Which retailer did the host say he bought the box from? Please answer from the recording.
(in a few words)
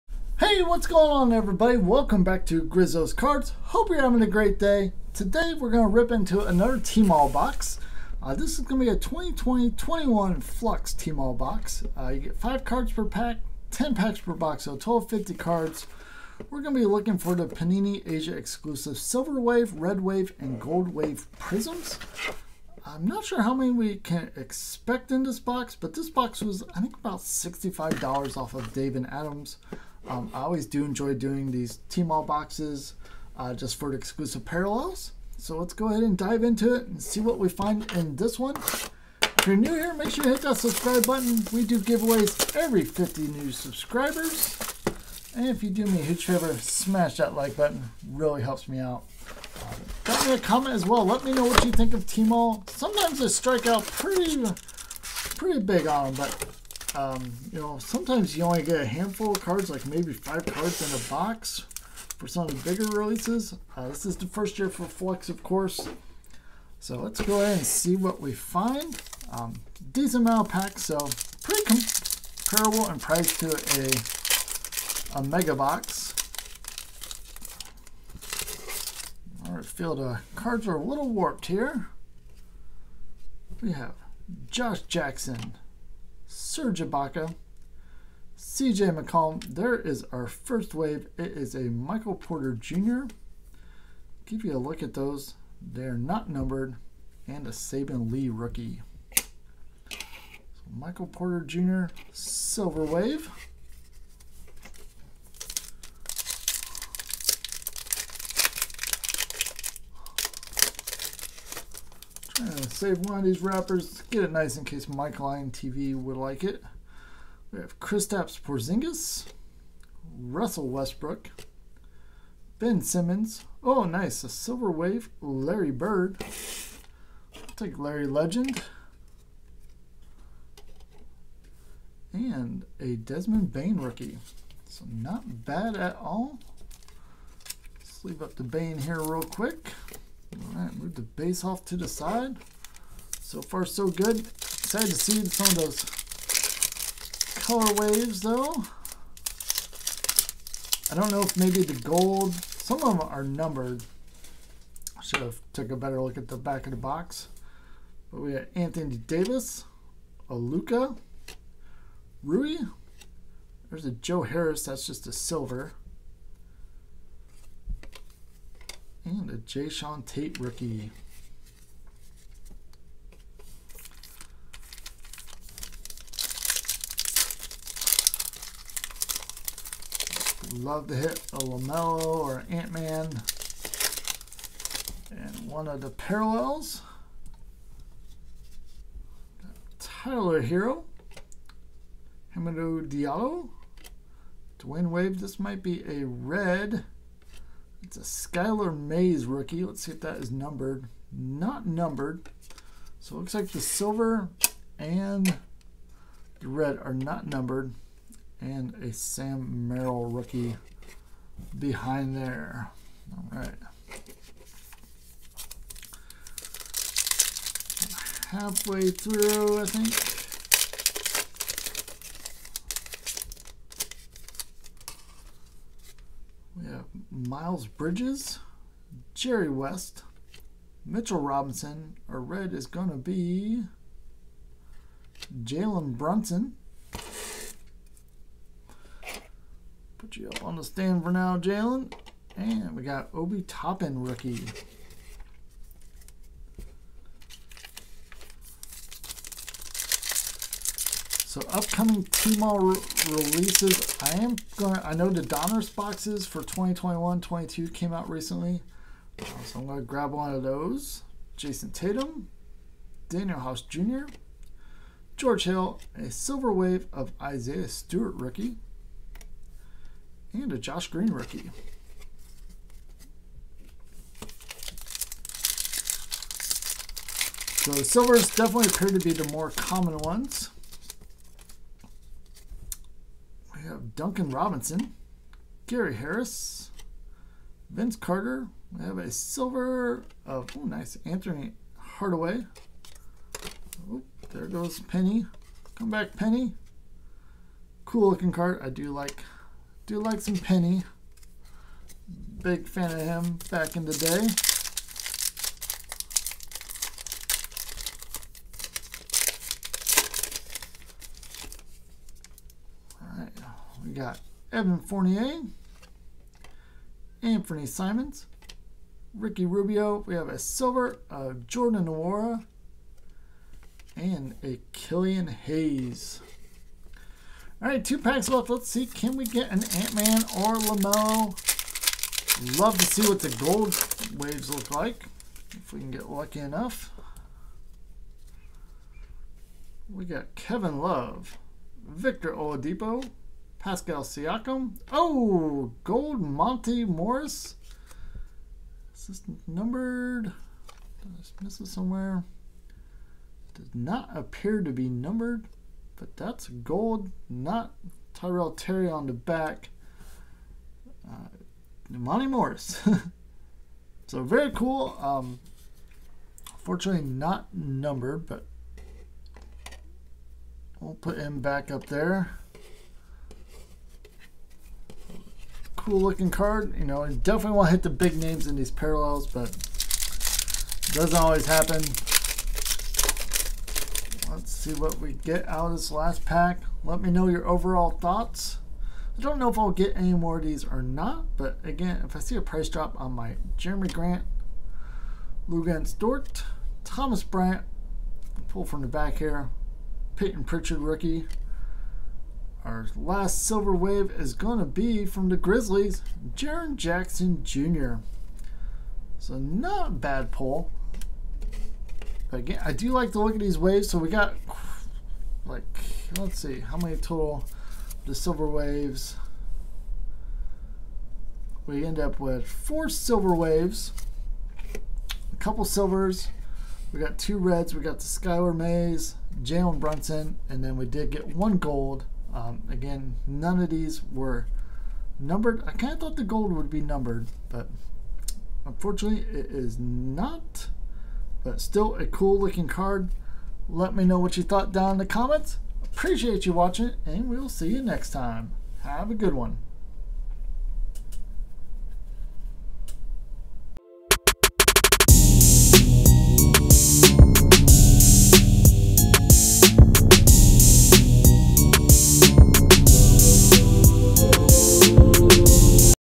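Dave and Adams.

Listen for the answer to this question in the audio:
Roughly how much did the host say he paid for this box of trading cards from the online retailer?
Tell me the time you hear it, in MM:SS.
00:26.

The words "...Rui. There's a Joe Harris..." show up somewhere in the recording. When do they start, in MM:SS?
02:42.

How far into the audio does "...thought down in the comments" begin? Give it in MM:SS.
07:24.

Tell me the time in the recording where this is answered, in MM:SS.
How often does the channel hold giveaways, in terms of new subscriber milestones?
00:42.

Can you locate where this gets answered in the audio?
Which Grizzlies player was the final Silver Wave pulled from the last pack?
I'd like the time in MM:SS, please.
06:46.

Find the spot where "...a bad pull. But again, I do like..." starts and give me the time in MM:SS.
06:49.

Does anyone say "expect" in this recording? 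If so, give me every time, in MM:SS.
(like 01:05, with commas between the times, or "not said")
00:24.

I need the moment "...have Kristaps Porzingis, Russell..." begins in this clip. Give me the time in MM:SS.
01:57.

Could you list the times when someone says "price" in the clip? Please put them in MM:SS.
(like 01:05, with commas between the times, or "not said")
01:12, 06:32.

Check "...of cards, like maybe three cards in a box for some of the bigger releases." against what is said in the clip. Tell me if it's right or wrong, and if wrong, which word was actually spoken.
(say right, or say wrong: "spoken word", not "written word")
wrong: "five", not "three".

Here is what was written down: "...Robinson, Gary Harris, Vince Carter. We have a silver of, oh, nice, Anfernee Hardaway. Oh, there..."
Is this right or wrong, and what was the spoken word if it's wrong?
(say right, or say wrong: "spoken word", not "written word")
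right.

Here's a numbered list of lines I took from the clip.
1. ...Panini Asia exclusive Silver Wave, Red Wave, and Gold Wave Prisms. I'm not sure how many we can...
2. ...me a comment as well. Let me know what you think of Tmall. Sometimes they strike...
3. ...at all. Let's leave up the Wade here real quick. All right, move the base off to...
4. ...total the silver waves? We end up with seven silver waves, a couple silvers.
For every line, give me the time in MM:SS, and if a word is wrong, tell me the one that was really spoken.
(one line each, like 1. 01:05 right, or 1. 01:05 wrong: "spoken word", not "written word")
1. 00:17 right
2. 00:50 right
3. 02:15 wrong: "Bane", not "Wade"
4. 06:56 wrong: "four", not "seven".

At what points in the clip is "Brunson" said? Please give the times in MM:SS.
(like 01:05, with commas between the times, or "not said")
03:55, 07:09.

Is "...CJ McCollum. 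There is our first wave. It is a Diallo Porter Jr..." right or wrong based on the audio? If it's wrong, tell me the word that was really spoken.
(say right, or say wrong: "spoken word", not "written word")
wrong: "Michael", not "Diallo".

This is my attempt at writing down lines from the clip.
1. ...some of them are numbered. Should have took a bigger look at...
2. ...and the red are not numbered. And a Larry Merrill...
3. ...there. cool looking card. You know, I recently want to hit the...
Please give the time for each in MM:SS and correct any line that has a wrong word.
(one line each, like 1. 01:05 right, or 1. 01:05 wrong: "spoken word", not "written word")
1. 02:32 wrong: "better", not "bigger"
2. 03:24 wrong: "Sam", not "Larry"
3. 06:11 wrong: "definitely", not "recently".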